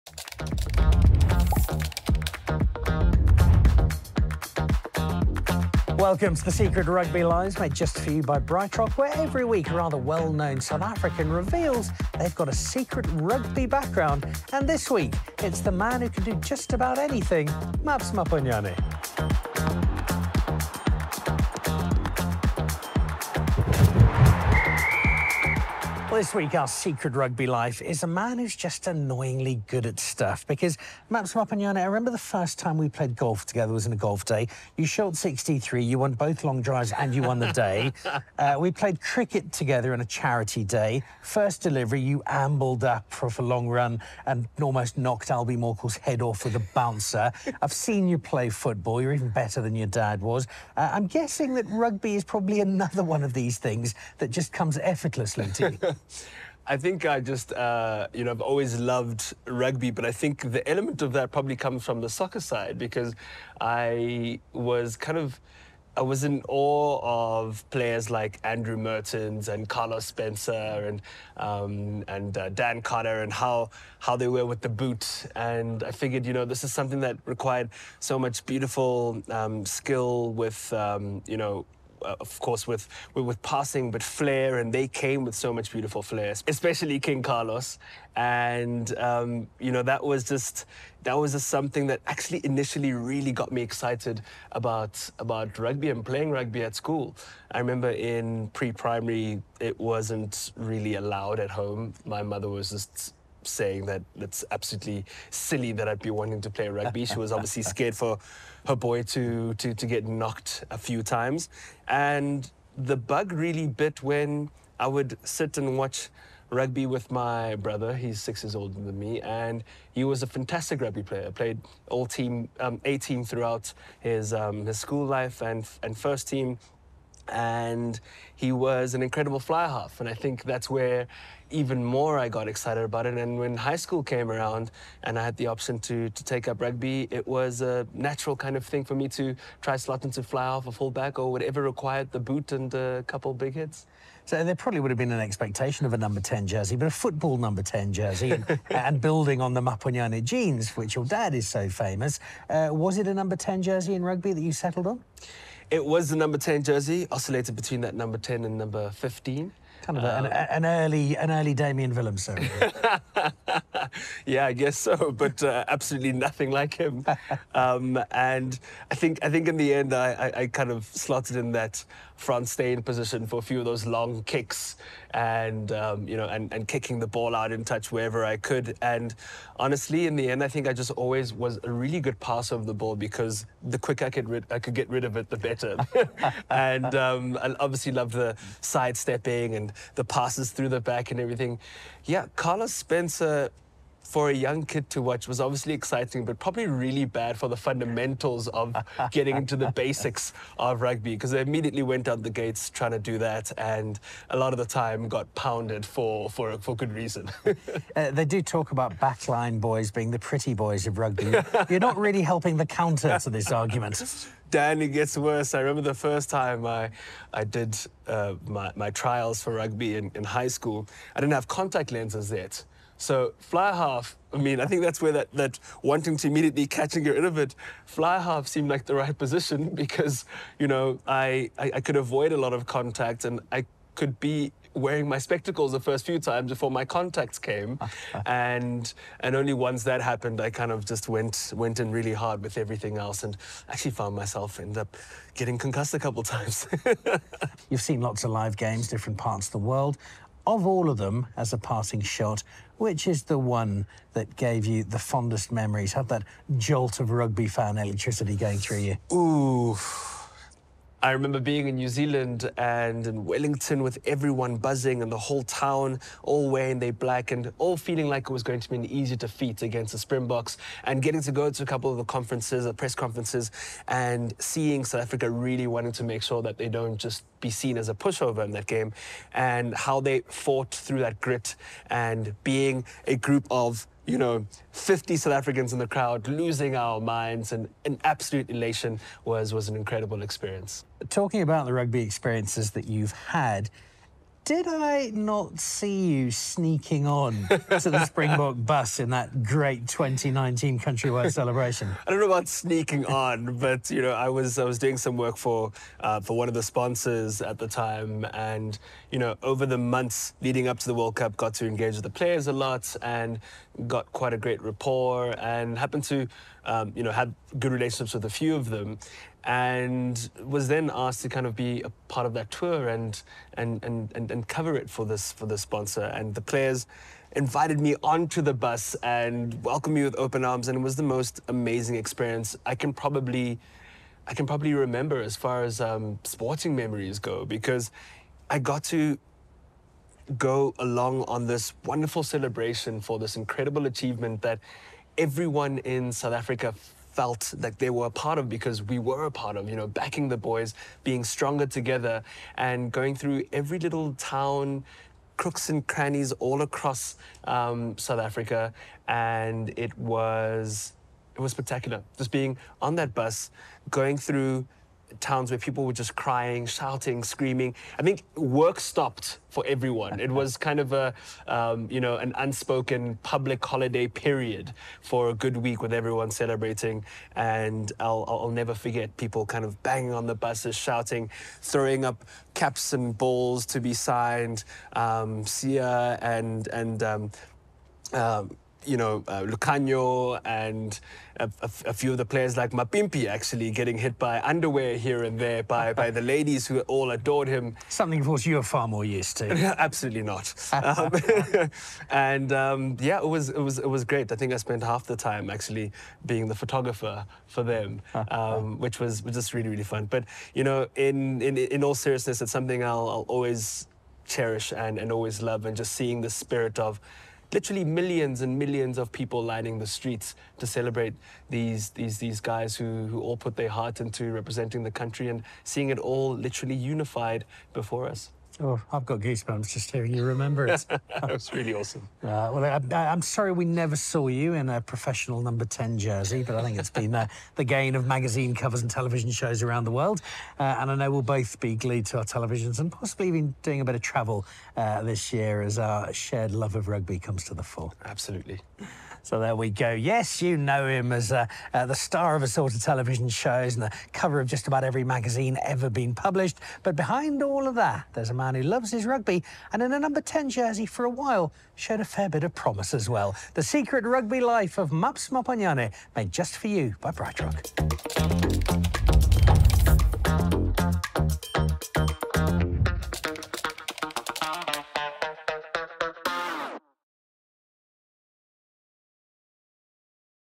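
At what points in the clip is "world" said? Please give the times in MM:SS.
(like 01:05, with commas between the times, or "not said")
04:09, 05:10, 07:19.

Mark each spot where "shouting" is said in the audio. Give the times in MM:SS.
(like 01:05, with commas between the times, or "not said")
06:06, 06:20.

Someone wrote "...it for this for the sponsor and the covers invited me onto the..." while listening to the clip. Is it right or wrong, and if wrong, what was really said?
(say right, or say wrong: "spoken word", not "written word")
wrong: "players", not "covers".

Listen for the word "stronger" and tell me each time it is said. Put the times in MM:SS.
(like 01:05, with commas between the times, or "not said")
05:51.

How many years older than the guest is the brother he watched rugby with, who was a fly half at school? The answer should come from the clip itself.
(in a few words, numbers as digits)
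6.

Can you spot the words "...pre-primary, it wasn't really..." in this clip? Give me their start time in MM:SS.
01:38.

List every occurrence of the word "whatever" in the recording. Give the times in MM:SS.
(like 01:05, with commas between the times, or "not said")
02:21.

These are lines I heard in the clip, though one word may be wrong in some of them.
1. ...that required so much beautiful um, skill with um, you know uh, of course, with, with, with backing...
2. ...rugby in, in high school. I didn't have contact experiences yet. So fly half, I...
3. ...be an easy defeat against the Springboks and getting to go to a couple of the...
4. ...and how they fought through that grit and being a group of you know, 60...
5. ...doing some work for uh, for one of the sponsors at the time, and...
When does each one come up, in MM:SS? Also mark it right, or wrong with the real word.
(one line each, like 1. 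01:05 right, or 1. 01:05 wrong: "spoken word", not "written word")
1. 01:17 wrong: "passing", not "backing"
2. 03:39 wrong: "lenses", not "experiences"
3. 04:28 right
4. 04:39 wrong: "50", not "60"
5. 05:04 right.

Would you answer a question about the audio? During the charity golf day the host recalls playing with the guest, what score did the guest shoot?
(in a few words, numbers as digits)
63.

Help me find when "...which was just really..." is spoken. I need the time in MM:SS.
06:48.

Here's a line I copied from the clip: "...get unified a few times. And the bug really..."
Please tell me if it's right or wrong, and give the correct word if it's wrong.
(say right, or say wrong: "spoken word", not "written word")
wrong: "knocked", not "unified".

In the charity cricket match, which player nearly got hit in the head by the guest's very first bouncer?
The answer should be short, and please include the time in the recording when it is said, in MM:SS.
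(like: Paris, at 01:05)
Albie Morkel, at 00:45.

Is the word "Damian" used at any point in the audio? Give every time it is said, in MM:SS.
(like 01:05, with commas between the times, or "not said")
02:41.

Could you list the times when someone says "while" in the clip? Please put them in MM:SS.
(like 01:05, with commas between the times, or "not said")
07:41.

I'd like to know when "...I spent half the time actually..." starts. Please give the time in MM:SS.
06:44.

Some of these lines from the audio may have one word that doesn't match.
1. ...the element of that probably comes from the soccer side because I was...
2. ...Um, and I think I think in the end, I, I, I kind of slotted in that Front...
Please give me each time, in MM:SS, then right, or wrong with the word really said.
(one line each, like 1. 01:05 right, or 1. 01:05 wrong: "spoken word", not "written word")
1. 01:00 right
2. 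02:47 right.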